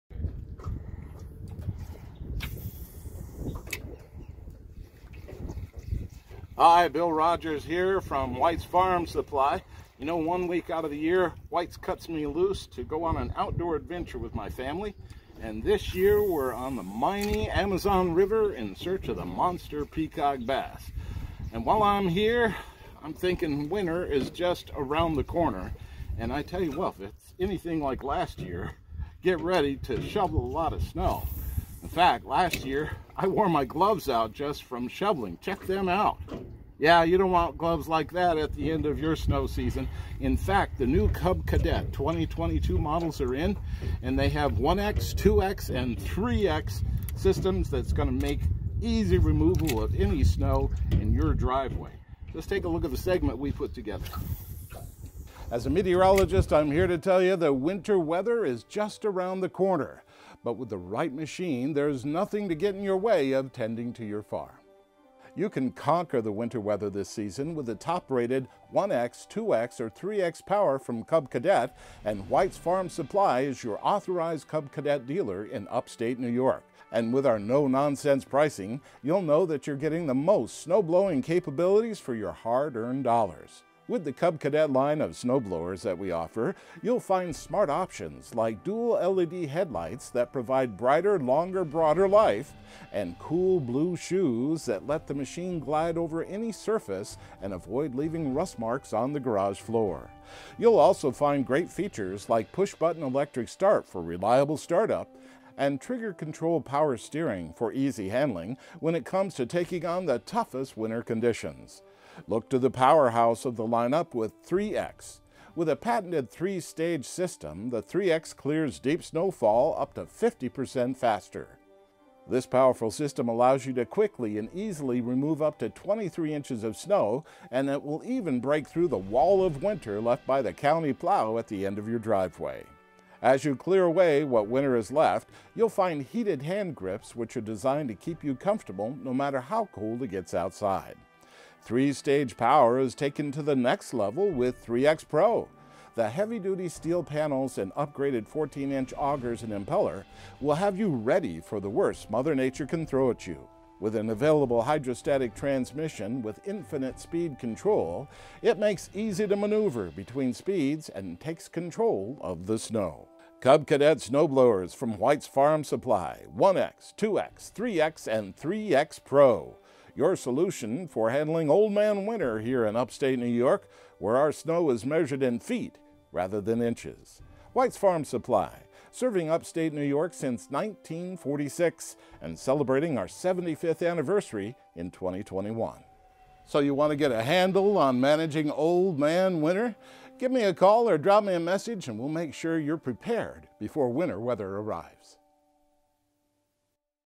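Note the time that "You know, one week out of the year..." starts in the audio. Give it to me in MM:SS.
00:09.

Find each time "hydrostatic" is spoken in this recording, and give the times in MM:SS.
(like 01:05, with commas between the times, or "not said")
02:34.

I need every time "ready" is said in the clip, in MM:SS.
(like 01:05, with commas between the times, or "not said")
00:29, 02:30.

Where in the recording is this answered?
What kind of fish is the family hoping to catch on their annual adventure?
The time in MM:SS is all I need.
00:19.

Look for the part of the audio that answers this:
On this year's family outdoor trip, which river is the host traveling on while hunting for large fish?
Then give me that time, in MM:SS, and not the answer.
00:17.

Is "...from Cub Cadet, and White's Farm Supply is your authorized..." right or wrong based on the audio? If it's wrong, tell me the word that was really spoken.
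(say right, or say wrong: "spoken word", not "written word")
right.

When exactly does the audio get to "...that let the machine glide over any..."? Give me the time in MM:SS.
01:34.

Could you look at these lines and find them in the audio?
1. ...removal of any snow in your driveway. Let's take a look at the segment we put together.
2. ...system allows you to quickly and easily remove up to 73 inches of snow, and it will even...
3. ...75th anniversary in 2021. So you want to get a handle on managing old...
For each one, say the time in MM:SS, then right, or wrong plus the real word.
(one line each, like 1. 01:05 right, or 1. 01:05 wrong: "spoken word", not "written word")
1. 00:49 right
2. 02:02 wrong: "23", not "73"
3. 03:03 right.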